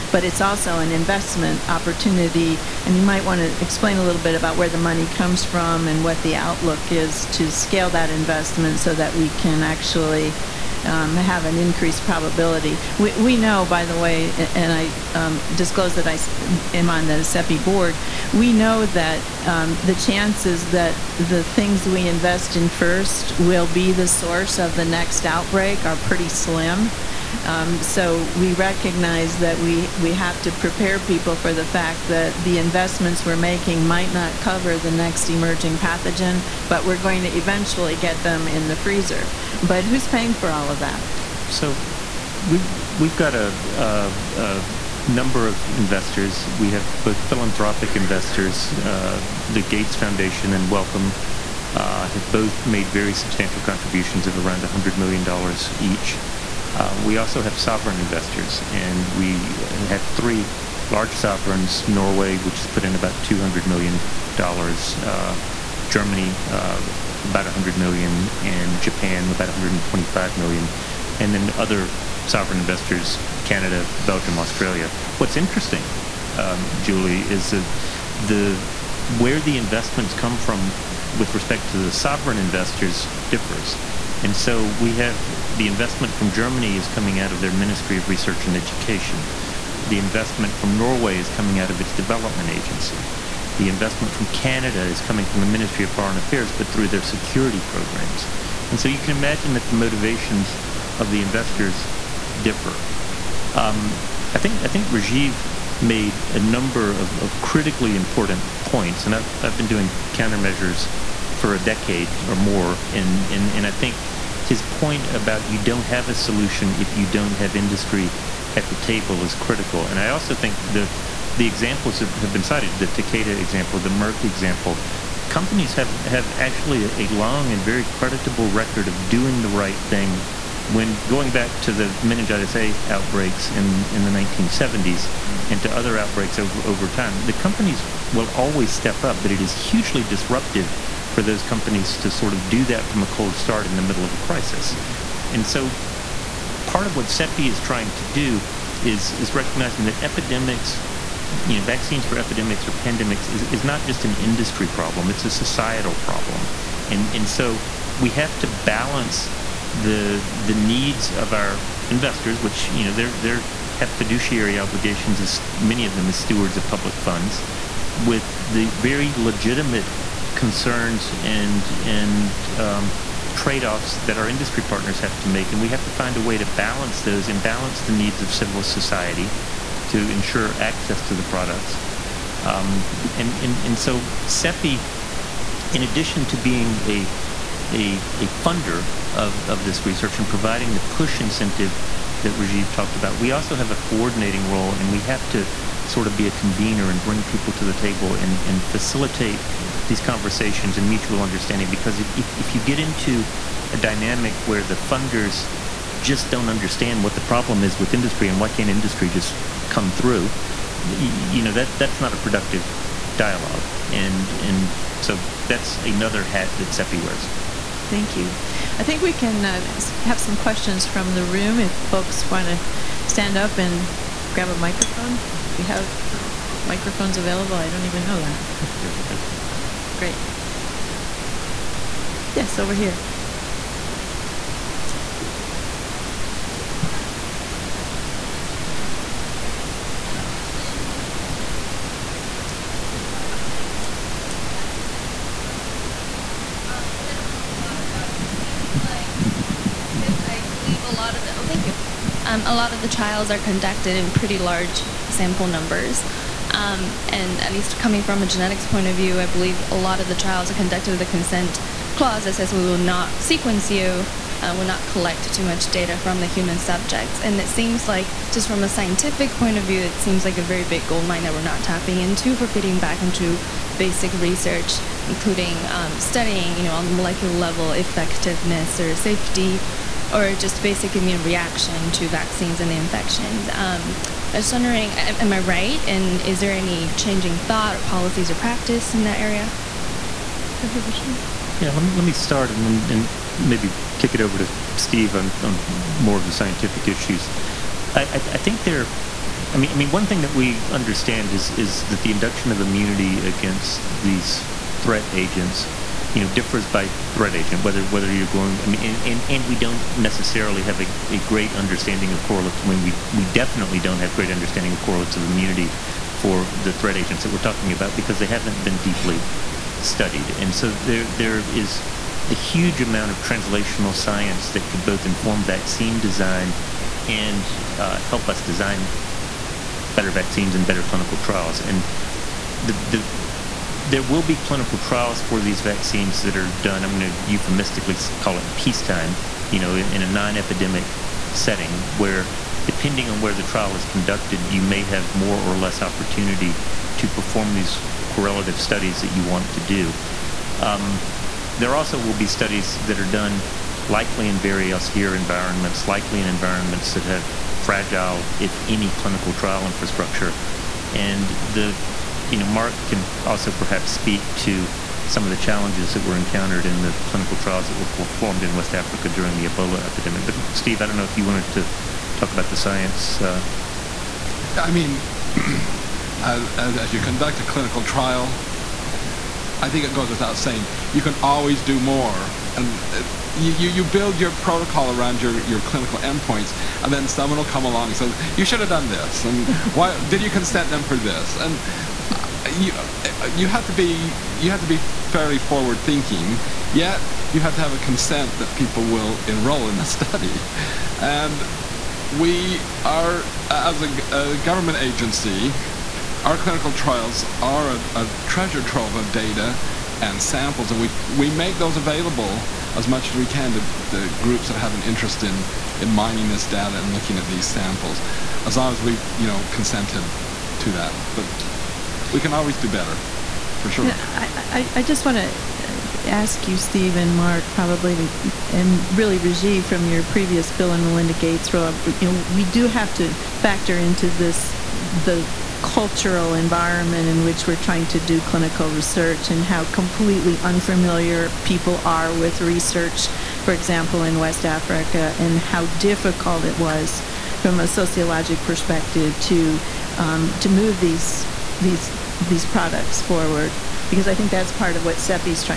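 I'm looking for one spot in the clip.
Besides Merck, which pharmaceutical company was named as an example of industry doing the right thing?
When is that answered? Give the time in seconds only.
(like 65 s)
122 s.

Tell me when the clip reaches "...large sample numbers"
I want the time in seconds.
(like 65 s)
254 s.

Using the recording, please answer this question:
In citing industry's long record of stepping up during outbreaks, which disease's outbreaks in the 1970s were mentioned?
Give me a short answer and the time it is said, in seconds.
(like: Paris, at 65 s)
Meningitis A, at 132 s.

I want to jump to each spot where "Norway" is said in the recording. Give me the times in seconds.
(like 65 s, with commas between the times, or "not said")
61 s, 90 s.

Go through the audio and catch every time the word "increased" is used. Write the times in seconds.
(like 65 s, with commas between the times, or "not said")
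11 s.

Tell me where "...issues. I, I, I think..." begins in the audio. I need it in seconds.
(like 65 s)
296 s.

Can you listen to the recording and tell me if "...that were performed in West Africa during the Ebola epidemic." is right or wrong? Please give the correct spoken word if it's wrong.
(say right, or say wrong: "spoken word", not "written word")
right.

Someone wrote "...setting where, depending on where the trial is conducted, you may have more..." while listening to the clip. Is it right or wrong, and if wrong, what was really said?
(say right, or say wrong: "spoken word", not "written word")
right.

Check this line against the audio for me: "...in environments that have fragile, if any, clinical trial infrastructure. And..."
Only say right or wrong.
right.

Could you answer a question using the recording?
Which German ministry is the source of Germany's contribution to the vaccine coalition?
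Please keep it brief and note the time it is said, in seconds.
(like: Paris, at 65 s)
Ministry of Research and Education, at 87 s.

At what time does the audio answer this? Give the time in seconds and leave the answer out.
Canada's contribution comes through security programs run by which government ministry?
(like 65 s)
95 s.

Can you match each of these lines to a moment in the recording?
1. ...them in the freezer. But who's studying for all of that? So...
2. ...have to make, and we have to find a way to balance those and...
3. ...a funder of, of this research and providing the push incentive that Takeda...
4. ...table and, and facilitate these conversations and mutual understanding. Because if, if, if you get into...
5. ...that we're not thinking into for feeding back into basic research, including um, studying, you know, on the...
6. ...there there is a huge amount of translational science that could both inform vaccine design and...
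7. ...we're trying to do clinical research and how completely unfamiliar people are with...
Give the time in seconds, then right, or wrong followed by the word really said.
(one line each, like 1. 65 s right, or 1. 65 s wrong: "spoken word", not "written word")
1. 38 s wrong: "paying", not "studying"
2. 175 s right
3. 188 s wrong: "Rajeev", not "Takeda"
4. 197 s right
5. 271 s wrong: "tapping", not "thinking"
6. 320 s right
7. 437 s right.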